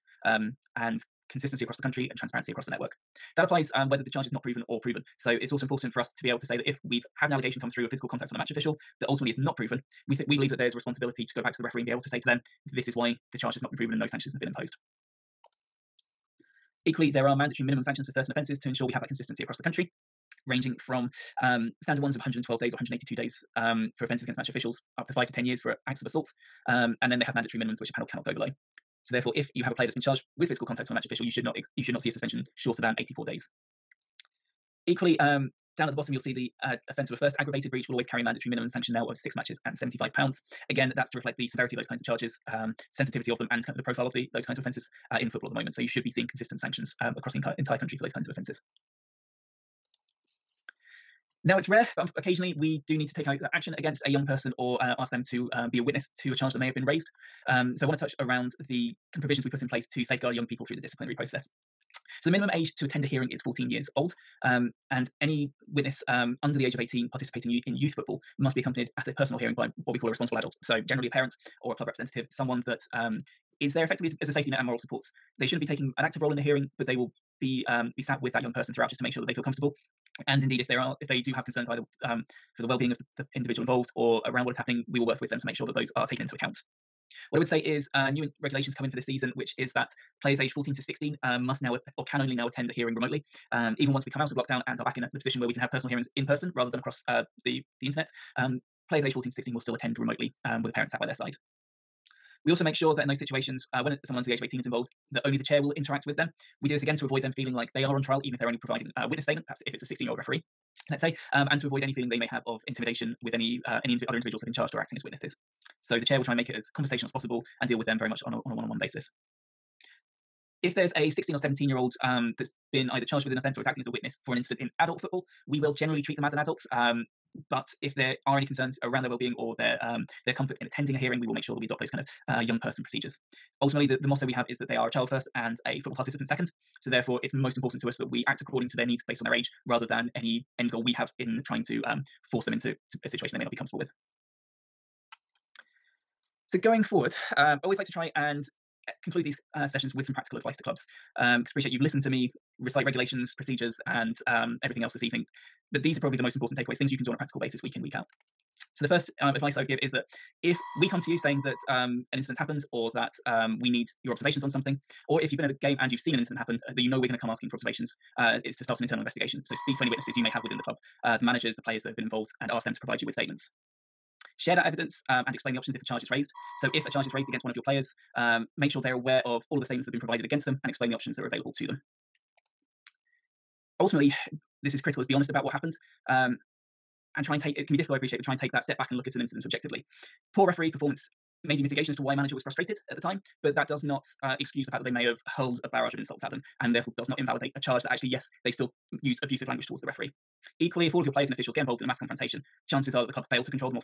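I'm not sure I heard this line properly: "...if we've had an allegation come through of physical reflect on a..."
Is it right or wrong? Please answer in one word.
wrong.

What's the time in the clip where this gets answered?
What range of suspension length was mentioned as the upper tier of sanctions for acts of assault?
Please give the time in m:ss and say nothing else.
0:25.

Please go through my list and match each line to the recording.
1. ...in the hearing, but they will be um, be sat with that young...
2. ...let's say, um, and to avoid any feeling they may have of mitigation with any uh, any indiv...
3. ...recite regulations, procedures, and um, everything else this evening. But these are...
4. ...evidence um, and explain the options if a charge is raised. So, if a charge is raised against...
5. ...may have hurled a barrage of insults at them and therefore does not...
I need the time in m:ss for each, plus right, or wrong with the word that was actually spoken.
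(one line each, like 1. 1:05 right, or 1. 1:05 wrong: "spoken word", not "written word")
1. 1:16 right
2. 1:50 wrong: "intimidation", not "mitigation"
3. 2:32 right
4. 2:54 right
5. 3:14 right.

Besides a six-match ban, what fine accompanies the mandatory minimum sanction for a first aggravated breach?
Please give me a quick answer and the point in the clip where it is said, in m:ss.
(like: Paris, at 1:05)
£75, at 0:39.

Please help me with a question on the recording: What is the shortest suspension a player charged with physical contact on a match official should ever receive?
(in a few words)
84 days.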